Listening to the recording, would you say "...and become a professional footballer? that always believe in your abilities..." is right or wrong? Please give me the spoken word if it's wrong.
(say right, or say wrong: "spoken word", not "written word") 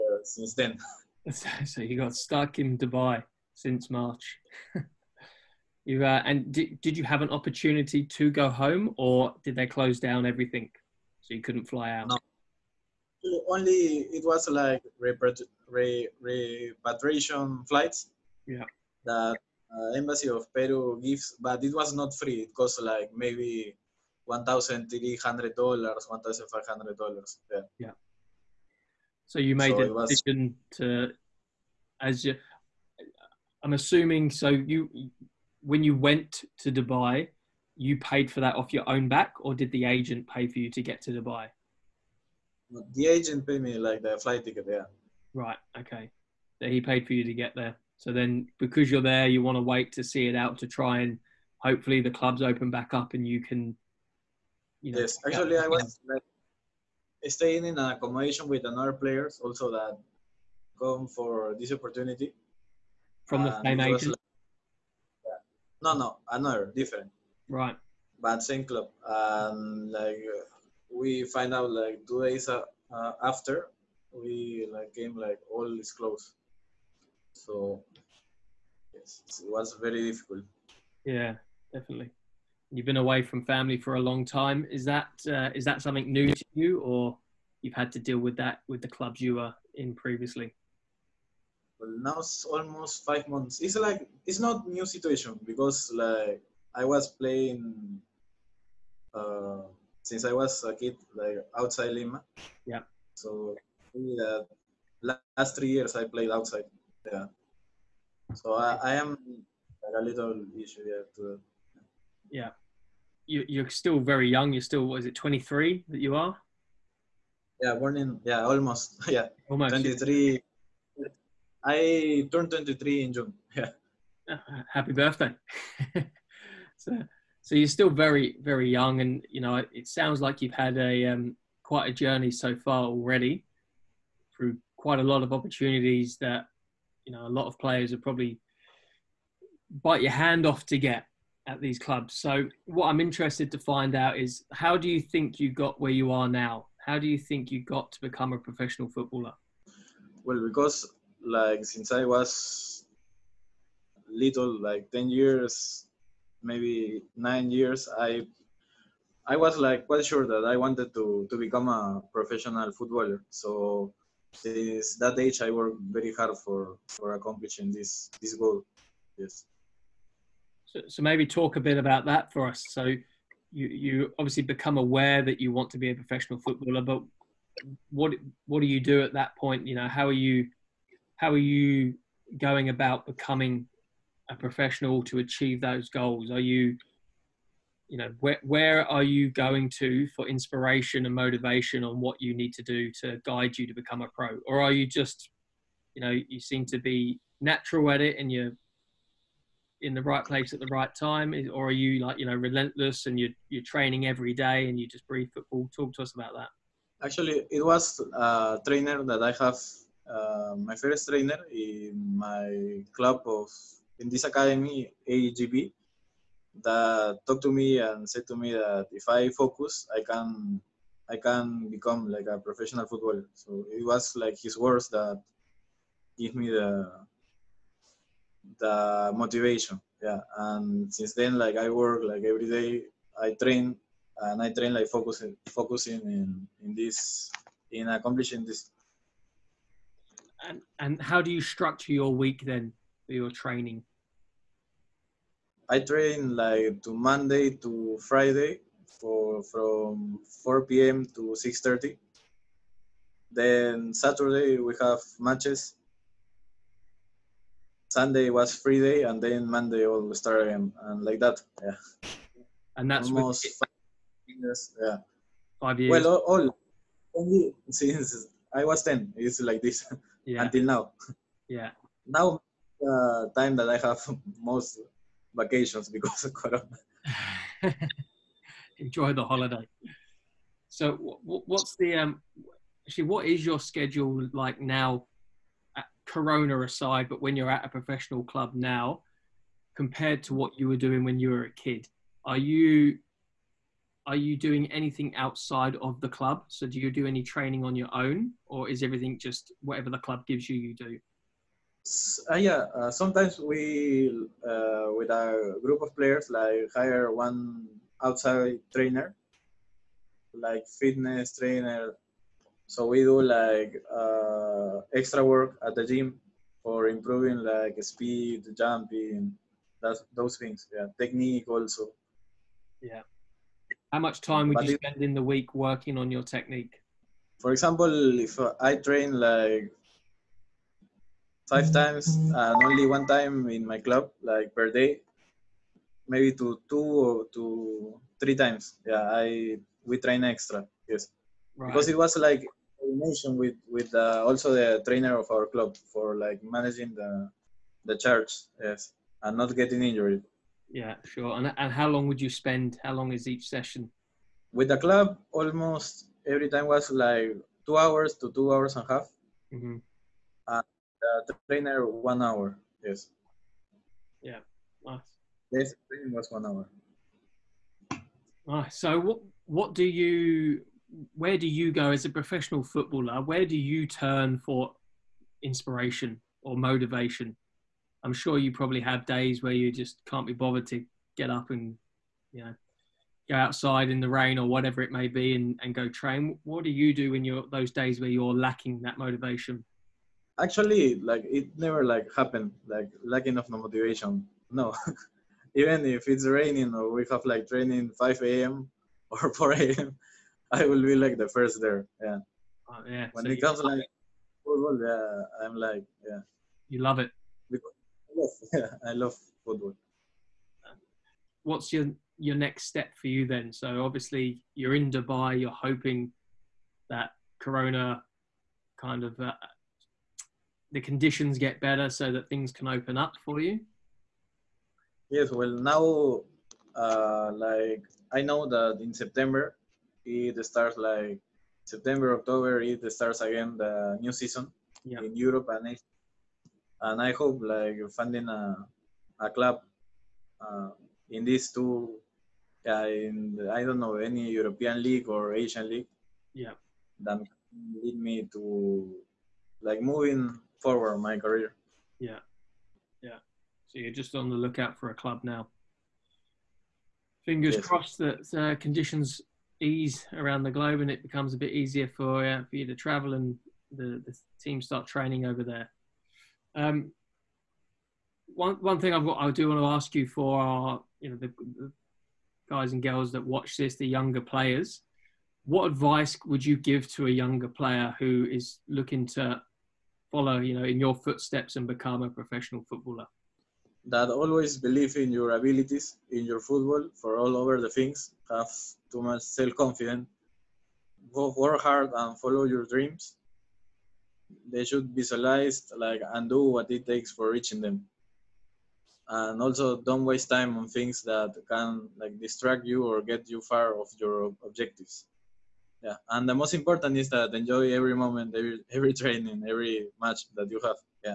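right.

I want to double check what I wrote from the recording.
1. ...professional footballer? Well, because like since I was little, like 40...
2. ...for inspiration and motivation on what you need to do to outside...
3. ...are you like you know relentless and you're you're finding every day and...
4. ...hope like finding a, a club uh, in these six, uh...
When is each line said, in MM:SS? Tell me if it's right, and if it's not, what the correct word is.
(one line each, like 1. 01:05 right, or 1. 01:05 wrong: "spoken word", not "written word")
1. 02:28 wrong: "10", not "40"
2. 03:10 wrong: "guide", not "outside"
3. 03:21 wrong: "training", not "finding"
4. 07:17 wrong: "two", not "six".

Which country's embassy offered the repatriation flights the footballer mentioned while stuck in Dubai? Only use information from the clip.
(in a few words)
Peru.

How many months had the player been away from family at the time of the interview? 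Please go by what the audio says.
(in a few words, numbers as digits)
5.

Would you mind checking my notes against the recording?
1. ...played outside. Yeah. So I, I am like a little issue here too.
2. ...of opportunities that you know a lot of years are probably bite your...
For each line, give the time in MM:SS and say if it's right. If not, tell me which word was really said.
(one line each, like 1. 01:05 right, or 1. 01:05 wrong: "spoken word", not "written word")
1. 01:46 right
2. 02:15 wrong: "players", not "years".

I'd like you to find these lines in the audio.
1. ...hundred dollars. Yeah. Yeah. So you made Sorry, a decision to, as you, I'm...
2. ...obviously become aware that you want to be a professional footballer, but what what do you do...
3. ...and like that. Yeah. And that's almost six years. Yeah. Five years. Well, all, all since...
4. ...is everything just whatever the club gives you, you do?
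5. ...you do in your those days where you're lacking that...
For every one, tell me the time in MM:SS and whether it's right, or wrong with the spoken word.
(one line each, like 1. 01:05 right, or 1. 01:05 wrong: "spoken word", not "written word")
1. 00:26 right
2. 02:54 right
3. 04:20 wrong: "five", not "six"
4. 04:58 right
5. 06:26 right.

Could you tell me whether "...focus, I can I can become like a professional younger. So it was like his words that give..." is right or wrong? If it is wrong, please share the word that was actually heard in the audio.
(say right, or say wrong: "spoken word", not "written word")
wrong: "footballer", not "younger".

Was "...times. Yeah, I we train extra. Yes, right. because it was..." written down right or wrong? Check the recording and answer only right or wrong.
right.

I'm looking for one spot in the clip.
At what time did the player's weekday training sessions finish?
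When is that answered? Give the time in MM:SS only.
04:11.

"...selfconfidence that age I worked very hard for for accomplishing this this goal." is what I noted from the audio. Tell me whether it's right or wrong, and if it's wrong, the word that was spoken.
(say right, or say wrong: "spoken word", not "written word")
wrong: "since", not "selfconfidence".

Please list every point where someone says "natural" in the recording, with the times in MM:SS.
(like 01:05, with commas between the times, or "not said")
03:17.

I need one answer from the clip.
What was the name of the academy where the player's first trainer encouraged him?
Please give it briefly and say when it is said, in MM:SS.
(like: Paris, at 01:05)
AGB, at 03:35.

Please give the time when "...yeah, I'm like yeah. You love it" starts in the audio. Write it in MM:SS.
06:44.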